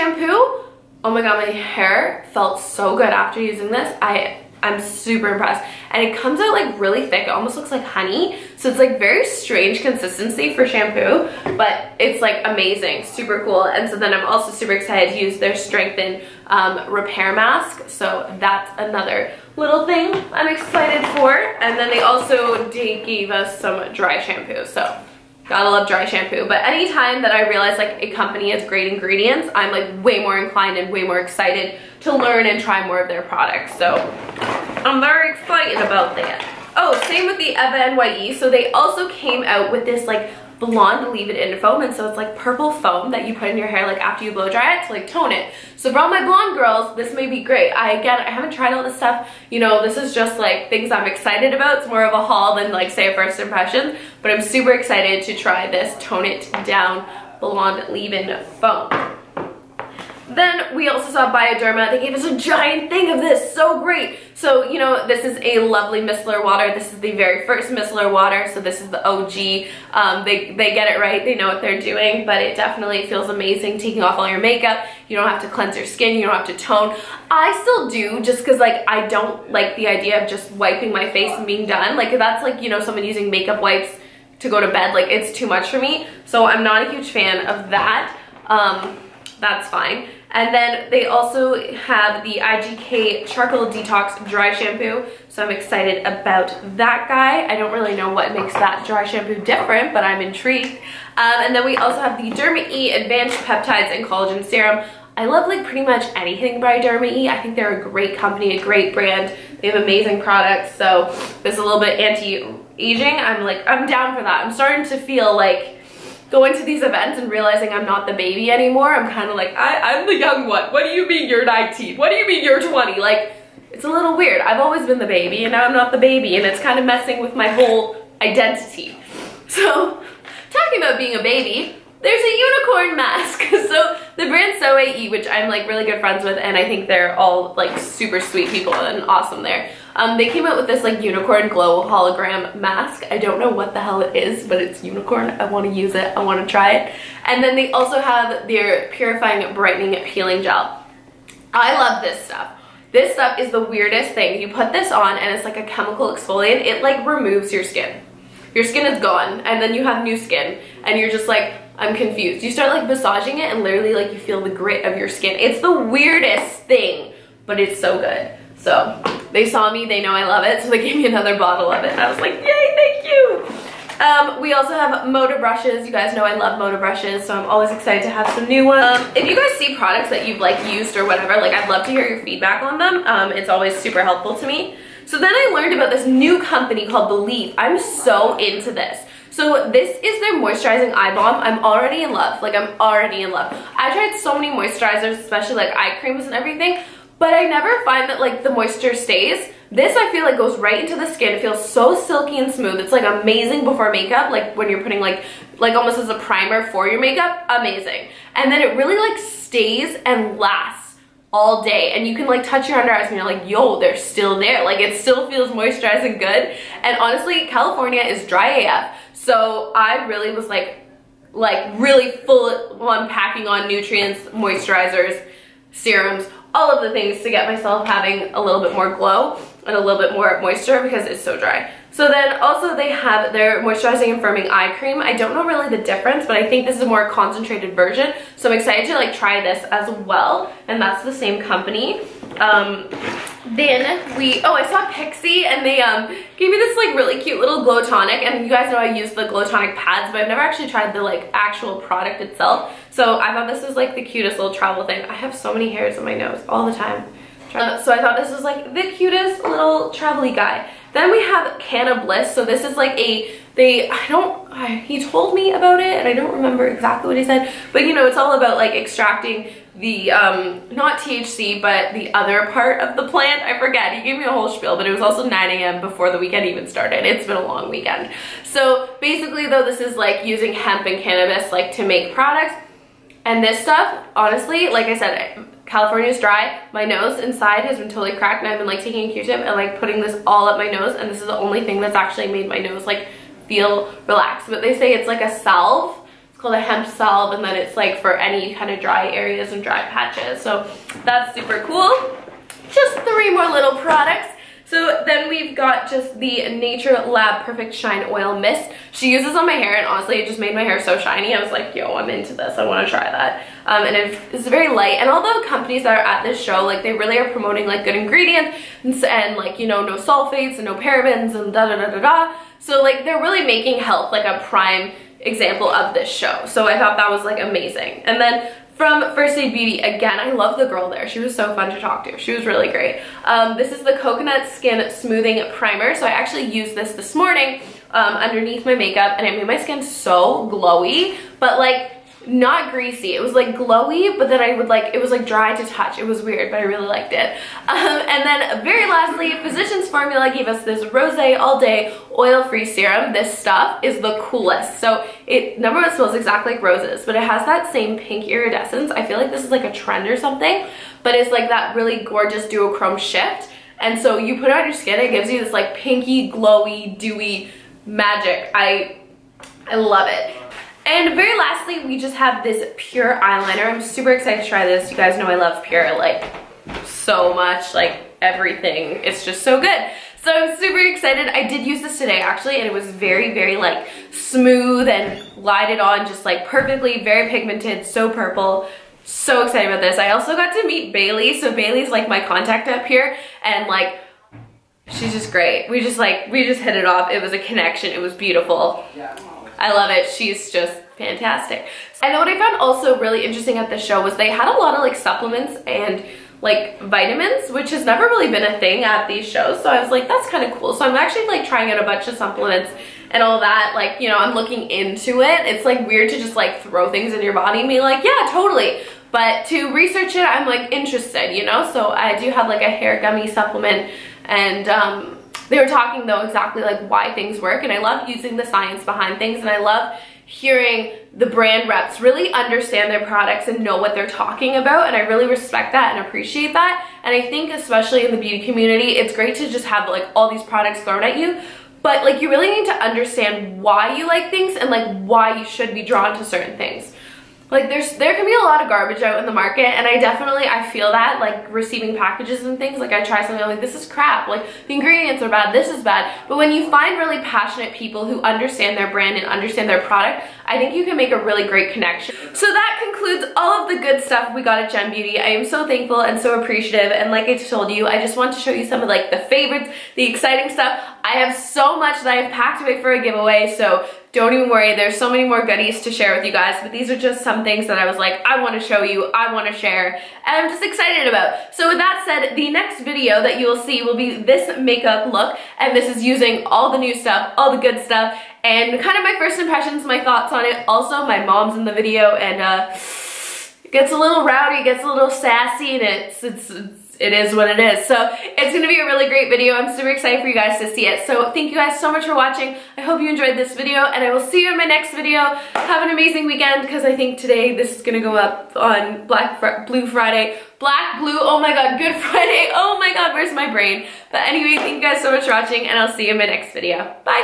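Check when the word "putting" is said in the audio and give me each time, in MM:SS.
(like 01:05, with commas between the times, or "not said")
03:24, 04:49.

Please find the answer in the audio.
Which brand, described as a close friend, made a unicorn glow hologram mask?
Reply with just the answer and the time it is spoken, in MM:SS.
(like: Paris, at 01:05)
Soo'AE, at 02:14.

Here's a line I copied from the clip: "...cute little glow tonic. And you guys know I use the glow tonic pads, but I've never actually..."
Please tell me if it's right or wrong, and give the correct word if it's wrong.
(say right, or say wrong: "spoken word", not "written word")
right.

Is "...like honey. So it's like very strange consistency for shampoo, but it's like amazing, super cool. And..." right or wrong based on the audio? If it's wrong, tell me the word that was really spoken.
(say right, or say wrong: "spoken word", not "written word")
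right.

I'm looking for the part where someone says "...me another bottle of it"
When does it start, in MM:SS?
02:50.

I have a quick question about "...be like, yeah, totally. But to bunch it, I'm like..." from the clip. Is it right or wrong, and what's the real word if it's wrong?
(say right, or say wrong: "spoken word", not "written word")
wrong: "research", not "bunch".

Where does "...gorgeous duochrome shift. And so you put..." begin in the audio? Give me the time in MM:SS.
06:02.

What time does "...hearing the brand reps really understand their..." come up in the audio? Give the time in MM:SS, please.
07:10.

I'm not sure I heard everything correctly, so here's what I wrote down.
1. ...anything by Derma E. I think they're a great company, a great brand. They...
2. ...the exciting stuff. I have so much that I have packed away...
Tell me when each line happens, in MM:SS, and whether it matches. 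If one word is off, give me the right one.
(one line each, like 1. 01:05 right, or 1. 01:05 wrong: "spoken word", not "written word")
1. 01:46 right
2. 07:49 right.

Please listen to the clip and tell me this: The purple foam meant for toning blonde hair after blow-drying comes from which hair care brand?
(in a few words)
Eva NYC.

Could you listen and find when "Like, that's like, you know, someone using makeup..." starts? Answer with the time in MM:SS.
01:21.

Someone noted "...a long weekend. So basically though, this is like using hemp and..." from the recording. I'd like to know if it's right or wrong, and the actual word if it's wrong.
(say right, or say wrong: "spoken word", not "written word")
right.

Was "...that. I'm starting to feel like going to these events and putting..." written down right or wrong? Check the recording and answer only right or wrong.
wrong.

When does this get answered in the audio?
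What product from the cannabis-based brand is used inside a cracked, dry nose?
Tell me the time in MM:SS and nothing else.
04:56.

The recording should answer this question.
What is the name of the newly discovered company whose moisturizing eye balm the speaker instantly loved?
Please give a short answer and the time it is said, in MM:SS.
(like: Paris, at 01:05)
belif, at 03:07.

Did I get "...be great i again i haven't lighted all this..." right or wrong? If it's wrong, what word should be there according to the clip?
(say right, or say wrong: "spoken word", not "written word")
wrong: "tried", not "lighted".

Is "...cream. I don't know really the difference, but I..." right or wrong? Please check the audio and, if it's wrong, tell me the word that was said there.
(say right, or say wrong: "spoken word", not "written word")
right.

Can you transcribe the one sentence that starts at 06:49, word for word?
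So I was like, that's kind of cool.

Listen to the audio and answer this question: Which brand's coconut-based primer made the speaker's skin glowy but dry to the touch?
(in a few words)
First Aid Beauty.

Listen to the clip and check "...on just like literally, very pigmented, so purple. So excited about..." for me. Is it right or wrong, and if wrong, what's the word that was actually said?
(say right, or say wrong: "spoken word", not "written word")
wrong: "perfectly", not "literally".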